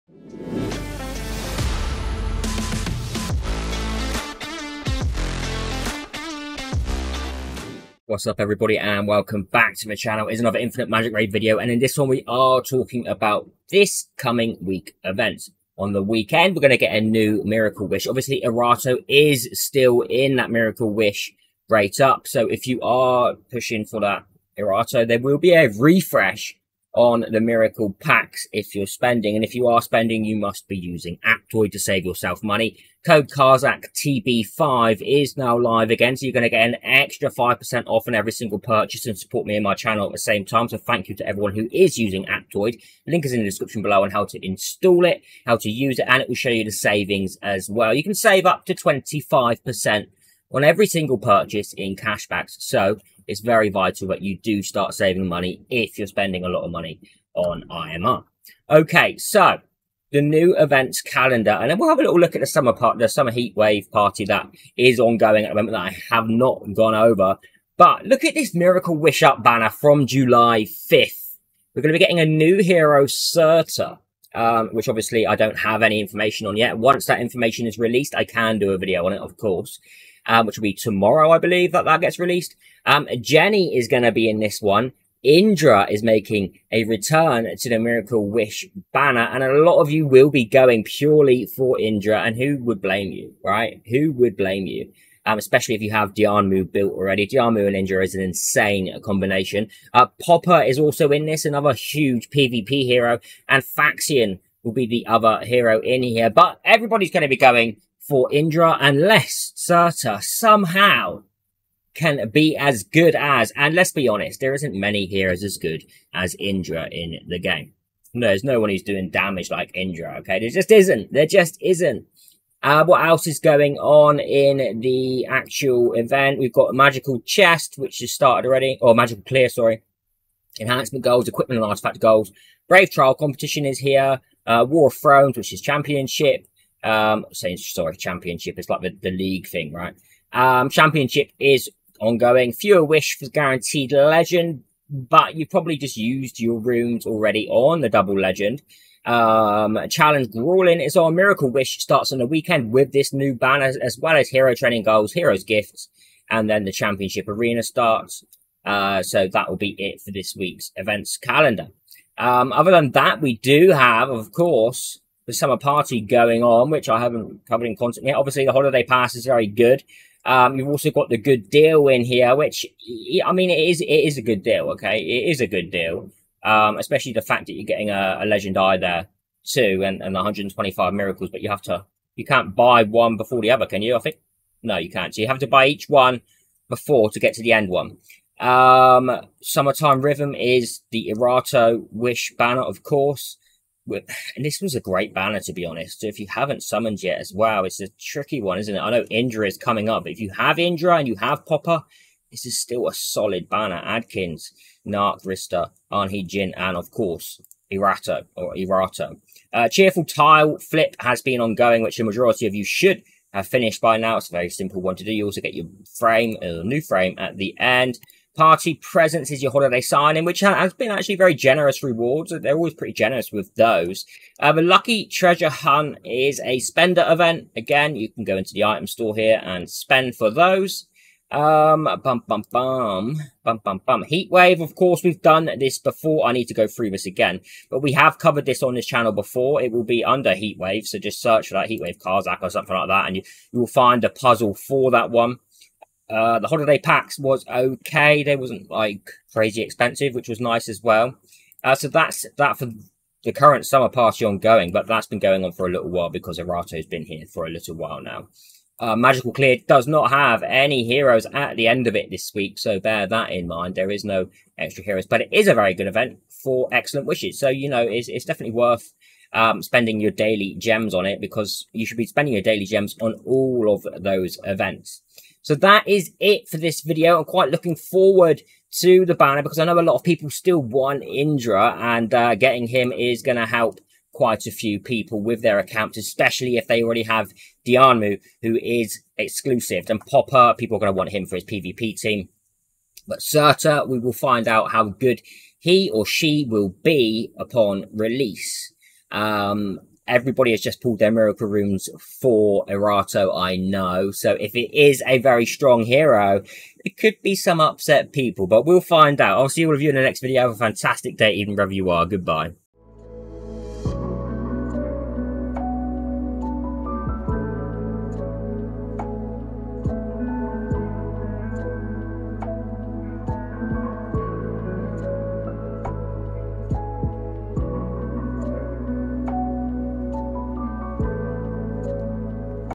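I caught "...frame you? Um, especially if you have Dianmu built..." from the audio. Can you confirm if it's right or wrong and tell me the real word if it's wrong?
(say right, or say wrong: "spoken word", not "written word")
wrong: "blame", not "frame".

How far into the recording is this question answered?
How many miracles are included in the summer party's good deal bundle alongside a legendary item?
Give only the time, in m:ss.
3:00.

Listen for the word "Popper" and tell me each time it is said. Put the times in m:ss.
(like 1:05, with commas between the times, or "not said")
1:40, 3:21, 4:50.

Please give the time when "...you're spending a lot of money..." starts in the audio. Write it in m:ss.
0:55.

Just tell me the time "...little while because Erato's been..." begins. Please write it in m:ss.
4:15.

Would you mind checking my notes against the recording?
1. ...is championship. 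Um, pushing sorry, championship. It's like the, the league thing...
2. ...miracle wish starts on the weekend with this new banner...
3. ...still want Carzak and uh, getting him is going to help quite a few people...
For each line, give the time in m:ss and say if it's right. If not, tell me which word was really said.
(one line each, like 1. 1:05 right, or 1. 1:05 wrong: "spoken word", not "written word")
1. 2:15 wrong: "saying", not "pushing"
2. 2:31 right
3. 4:40 wrong: "Indra", not "Carzak".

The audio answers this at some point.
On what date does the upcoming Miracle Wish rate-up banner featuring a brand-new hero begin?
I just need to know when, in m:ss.
1:10.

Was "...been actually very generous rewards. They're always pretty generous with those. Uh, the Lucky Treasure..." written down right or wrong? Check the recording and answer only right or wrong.
right.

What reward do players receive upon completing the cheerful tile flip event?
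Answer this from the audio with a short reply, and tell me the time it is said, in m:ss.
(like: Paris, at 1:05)
A new frame, at 3:36.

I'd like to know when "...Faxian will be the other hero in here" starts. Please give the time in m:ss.
1:43.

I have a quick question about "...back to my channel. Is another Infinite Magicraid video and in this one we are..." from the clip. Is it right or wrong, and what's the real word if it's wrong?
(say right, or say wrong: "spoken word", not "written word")
right.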